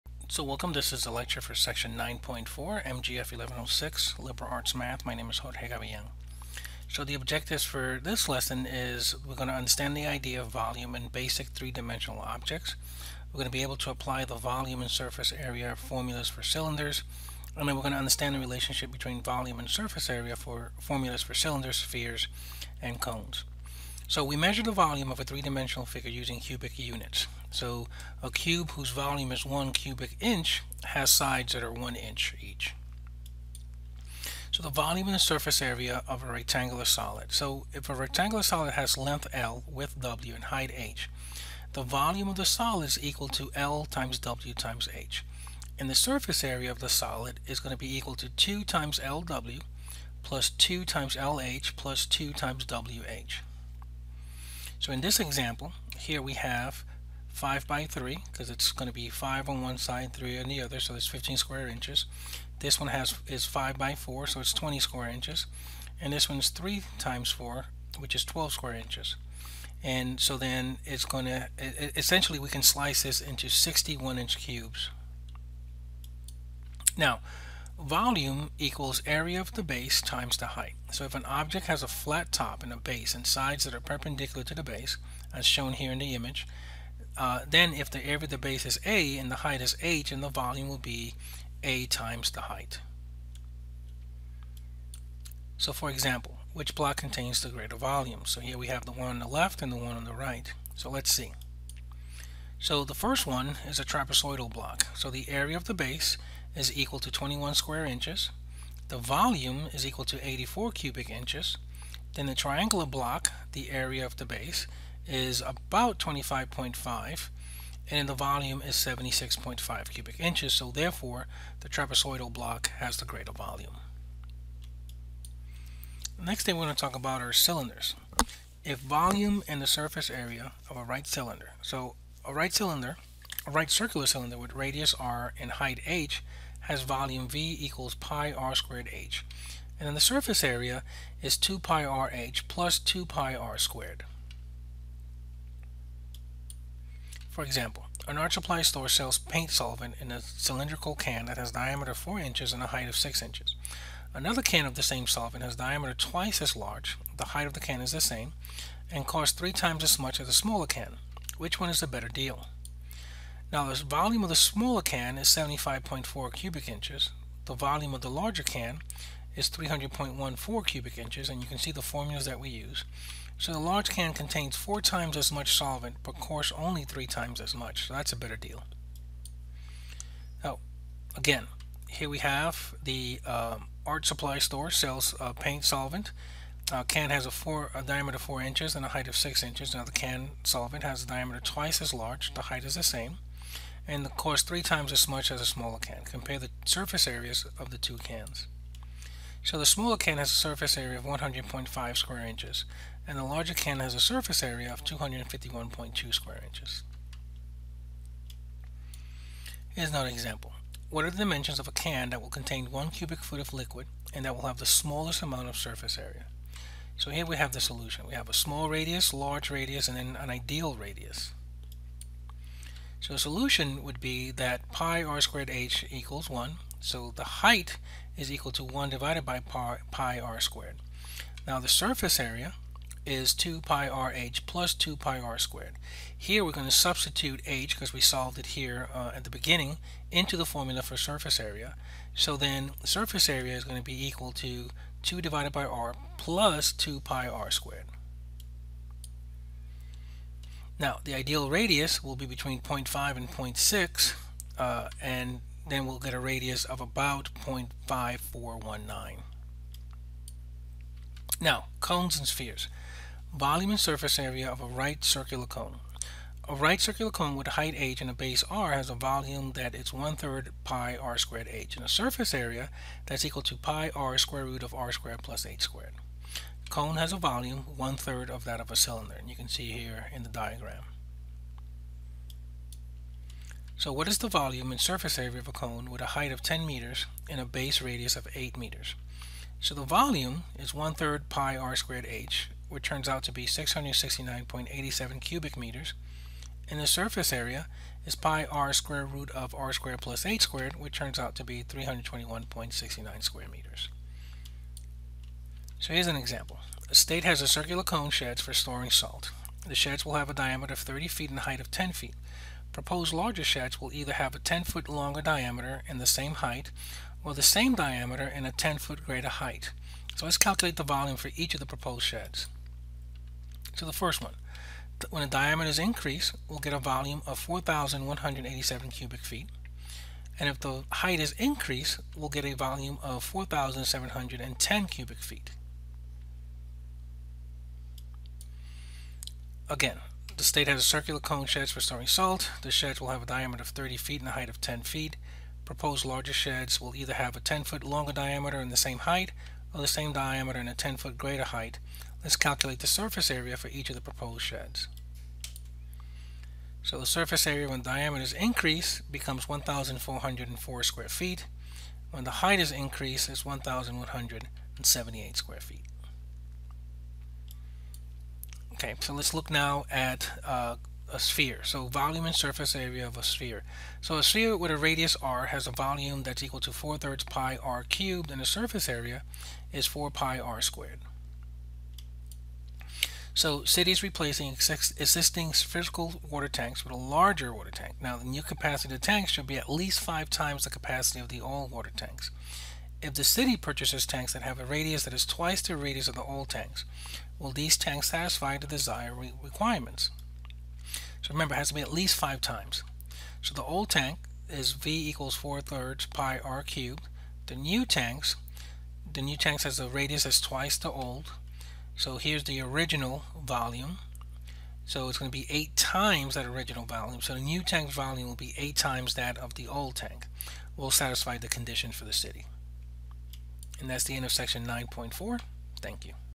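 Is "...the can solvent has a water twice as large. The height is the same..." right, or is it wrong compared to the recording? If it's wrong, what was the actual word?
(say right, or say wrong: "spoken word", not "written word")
wrong: "diameter", not "water".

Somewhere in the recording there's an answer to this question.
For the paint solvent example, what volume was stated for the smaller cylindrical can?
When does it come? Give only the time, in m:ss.
2:45.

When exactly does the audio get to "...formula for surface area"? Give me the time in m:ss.
4:00.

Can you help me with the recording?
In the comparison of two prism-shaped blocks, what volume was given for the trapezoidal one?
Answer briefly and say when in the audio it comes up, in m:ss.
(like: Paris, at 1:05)
84 cubic inches, at 1:50.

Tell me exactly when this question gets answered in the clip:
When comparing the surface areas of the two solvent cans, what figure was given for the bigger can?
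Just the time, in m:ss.
3:24.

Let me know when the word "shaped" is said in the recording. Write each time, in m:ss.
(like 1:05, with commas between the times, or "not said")
not said.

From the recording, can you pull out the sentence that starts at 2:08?
If volume and the surface area of a right cylinder.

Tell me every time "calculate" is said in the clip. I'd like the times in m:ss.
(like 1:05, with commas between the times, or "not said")
5:20, 5:52.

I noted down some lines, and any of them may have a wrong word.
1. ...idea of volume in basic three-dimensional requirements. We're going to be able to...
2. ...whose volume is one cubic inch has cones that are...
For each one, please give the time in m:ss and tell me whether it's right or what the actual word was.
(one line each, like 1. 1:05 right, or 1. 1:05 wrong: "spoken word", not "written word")
1. 0:10 wrong: "objects", not "requirements"
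2. 0:28 wrong: "sides", not "cones".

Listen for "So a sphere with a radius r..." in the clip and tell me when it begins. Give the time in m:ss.
6:14.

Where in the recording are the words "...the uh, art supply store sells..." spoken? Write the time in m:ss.
3:02.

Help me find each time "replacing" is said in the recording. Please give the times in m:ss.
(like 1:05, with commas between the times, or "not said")
6:24.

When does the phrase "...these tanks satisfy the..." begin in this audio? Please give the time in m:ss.
6:37.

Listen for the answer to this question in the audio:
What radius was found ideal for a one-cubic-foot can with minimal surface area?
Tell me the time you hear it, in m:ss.
4:17.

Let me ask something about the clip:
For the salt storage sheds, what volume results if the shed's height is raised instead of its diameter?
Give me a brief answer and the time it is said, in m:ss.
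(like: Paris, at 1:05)
4,710 cubic feet, at 5:33.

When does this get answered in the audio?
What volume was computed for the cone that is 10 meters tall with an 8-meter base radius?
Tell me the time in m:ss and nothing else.
4:53.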